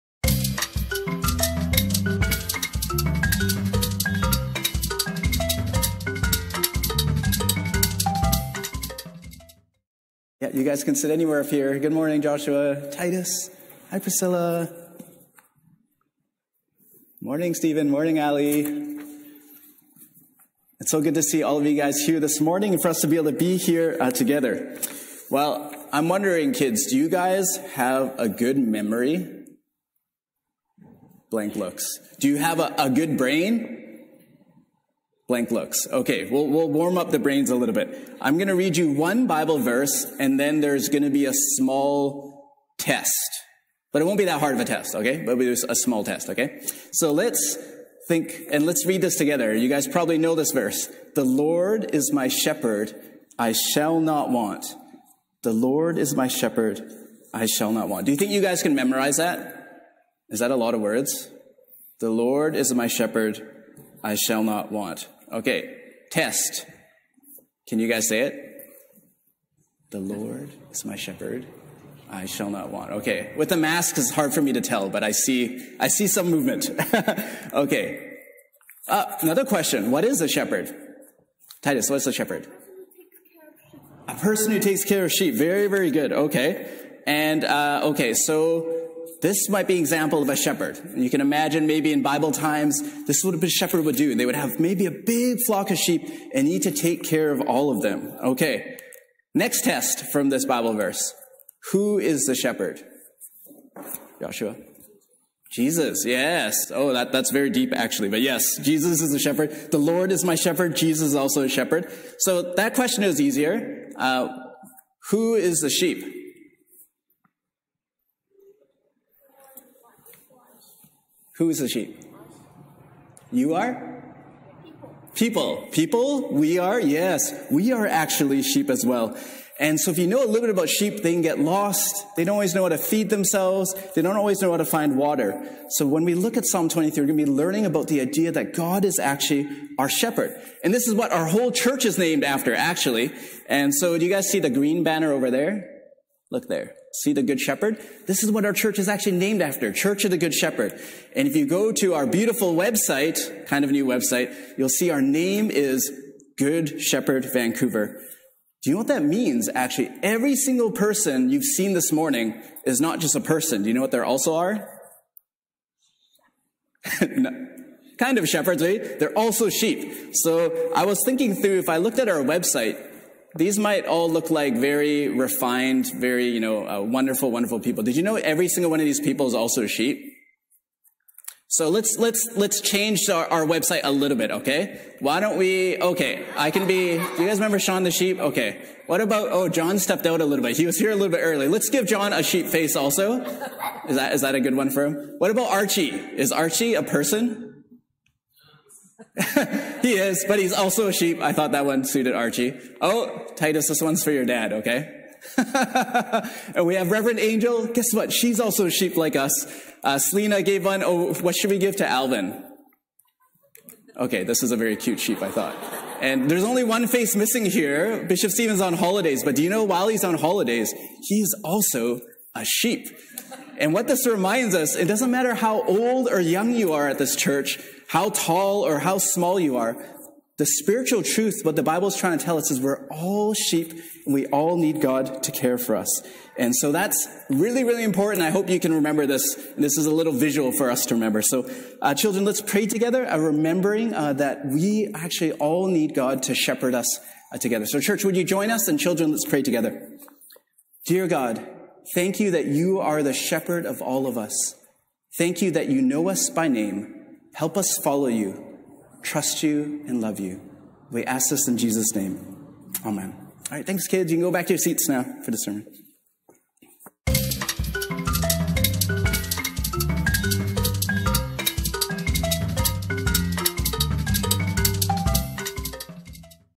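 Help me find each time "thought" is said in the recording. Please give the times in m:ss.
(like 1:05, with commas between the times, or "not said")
3:21, 3:35.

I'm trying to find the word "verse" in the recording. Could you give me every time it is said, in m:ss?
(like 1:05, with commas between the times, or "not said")
0:39, 0:50, 1:40.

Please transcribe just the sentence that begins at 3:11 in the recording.
Let's give John a sheep face also.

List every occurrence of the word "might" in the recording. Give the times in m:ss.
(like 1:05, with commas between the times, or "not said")
1:29, 2:53.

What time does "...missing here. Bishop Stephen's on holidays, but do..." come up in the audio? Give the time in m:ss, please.
3:37.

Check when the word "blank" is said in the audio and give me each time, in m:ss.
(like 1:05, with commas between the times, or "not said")
0:31, 0:35.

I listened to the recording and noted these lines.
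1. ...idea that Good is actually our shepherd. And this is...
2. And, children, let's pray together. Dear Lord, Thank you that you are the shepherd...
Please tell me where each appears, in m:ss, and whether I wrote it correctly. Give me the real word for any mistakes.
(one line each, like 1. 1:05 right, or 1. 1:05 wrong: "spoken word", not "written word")
1. 2:18 wrong: "God", not "Good"
2. 4:08 wrong: "God", not "Lord".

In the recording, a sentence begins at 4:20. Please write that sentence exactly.
We ask this in Jesus' name.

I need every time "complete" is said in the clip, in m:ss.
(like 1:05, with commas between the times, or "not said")
not said.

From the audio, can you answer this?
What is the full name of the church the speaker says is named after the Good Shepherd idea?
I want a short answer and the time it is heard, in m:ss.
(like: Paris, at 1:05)
Church of the Good Shepherd, at 2:29.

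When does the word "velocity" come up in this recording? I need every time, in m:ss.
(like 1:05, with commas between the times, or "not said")
not said.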